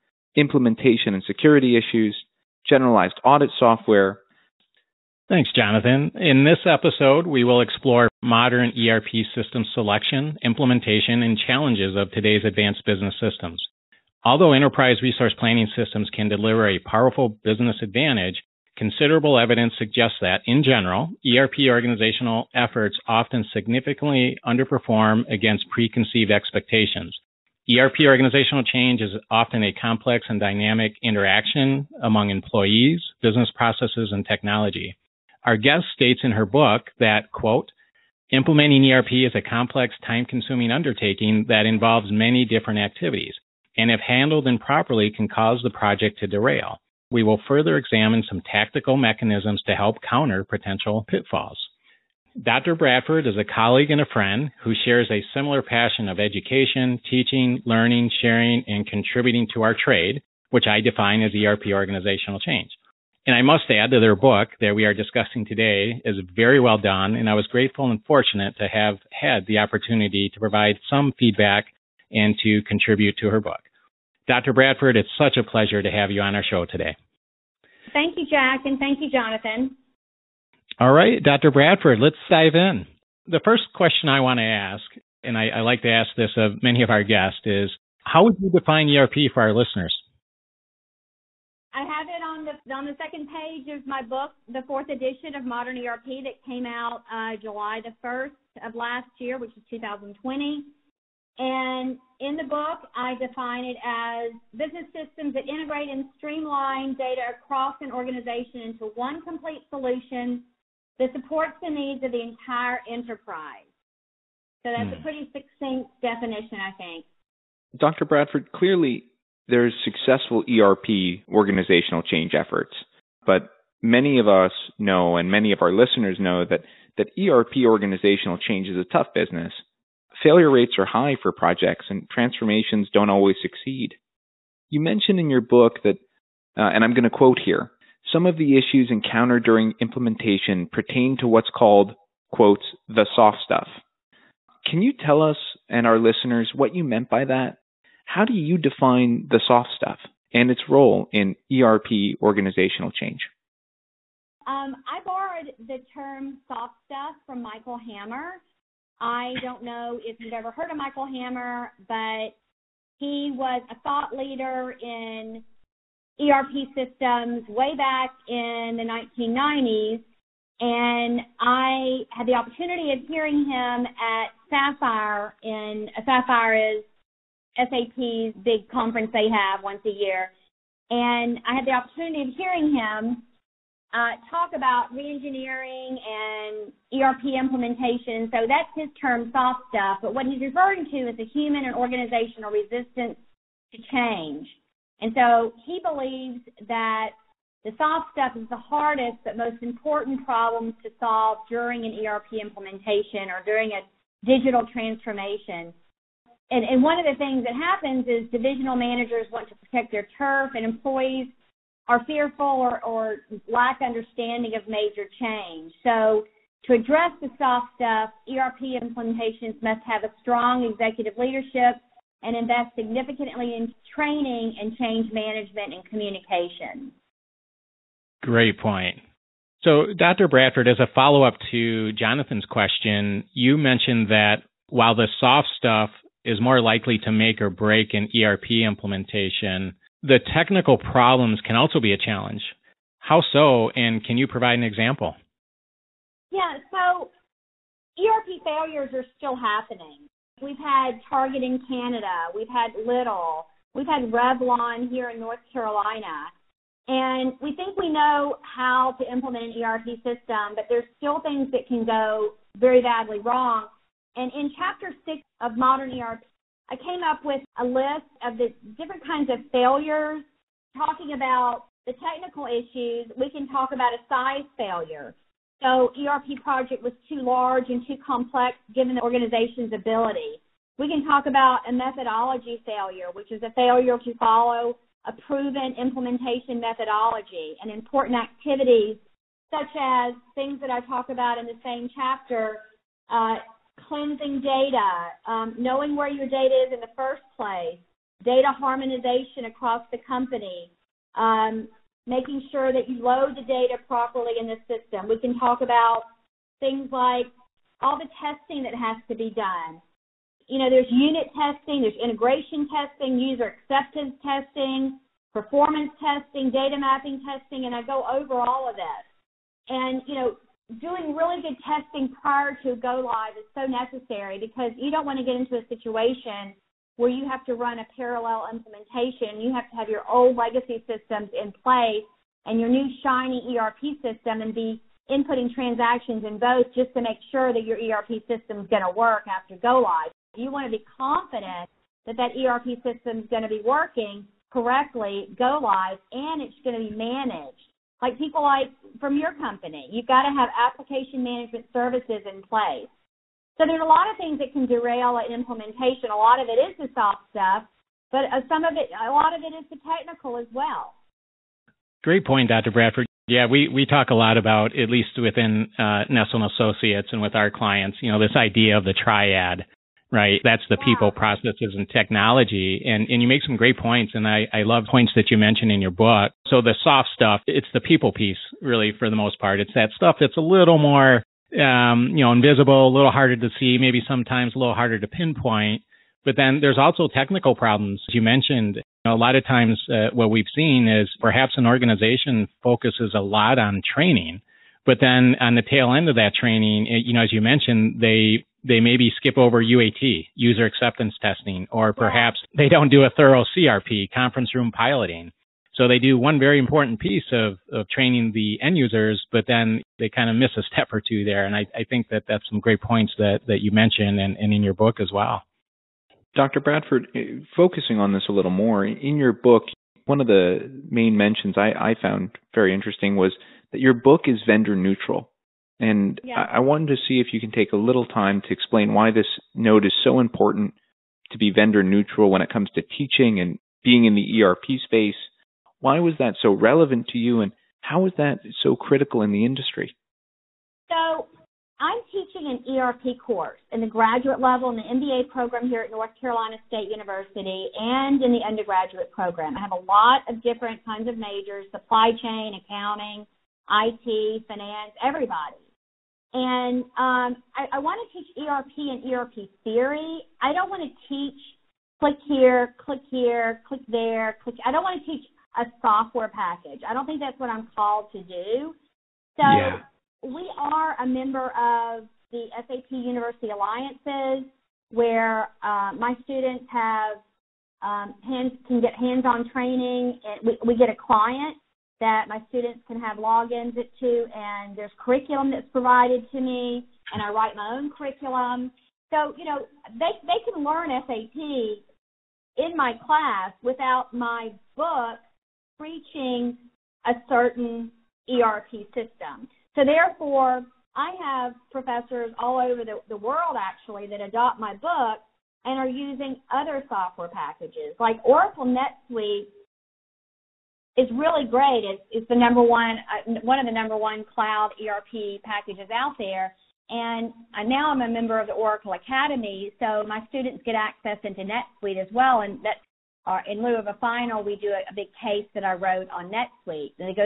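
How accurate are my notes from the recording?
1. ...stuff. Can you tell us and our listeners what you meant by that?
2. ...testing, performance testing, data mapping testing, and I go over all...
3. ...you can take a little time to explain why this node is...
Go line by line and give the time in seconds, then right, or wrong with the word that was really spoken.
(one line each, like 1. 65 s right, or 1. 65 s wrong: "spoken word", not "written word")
1. 143 s right
2. 314 s right
3. 427 s right.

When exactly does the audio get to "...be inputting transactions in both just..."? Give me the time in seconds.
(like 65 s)
334 s.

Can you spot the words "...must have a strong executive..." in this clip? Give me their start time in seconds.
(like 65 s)
219 s.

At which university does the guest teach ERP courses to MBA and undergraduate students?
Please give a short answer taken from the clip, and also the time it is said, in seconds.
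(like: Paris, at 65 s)
North Carolina State University, at 445 s.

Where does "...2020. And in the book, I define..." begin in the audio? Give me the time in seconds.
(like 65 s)
99 s.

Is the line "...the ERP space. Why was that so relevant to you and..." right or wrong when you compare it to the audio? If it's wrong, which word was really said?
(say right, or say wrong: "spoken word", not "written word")
right.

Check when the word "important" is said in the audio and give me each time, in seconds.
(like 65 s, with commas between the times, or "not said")
199 s, 287 s, 406 s, 430 s.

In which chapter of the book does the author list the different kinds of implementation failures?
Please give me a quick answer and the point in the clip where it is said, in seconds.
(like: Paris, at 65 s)
Chapter 6, at 264 s.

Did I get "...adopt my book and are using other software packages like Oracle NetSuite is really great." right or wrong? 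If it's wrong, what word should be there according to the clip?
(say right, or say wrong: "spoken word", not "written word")
right.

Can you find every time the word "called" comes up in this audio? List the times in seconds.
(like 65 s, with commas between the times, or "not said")
141 s, 467 s.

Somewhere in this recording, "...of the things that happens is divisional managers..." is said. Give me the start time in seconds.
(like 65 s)
206 s.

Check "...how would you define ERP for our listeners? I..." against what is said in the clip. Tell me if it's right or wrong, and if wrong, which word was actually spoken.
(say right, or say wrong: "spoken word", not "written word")
right.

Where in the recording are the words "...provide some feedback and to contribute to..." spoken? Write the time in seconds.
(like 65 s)
70 s.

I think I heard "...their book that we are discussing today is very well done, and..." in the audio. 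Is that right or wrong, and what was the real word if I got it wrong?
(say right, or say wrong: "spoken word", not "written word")
right.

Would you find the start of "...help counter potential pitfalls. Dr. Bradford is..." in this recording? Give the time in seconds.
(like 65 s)
49 s.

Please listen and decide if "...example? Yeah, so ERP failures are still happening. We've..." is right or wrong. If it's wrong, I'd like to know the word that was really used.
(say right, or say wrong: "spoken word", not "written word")
right.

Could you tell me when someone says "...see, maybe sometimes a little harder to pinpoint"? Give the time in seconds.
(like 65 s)
383 s.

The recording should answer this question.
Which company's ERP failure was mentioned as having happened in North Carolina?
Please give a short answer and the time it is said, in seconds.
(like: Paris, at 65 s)
Revlon, at 254 s.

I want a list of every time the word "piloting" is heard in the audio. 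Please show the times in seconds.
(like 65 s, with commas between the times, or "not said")
404 s.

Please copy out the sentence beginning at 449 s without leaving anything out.
I have a lot of different kinds of majors supply chain, accounting, IT, finance, everybody.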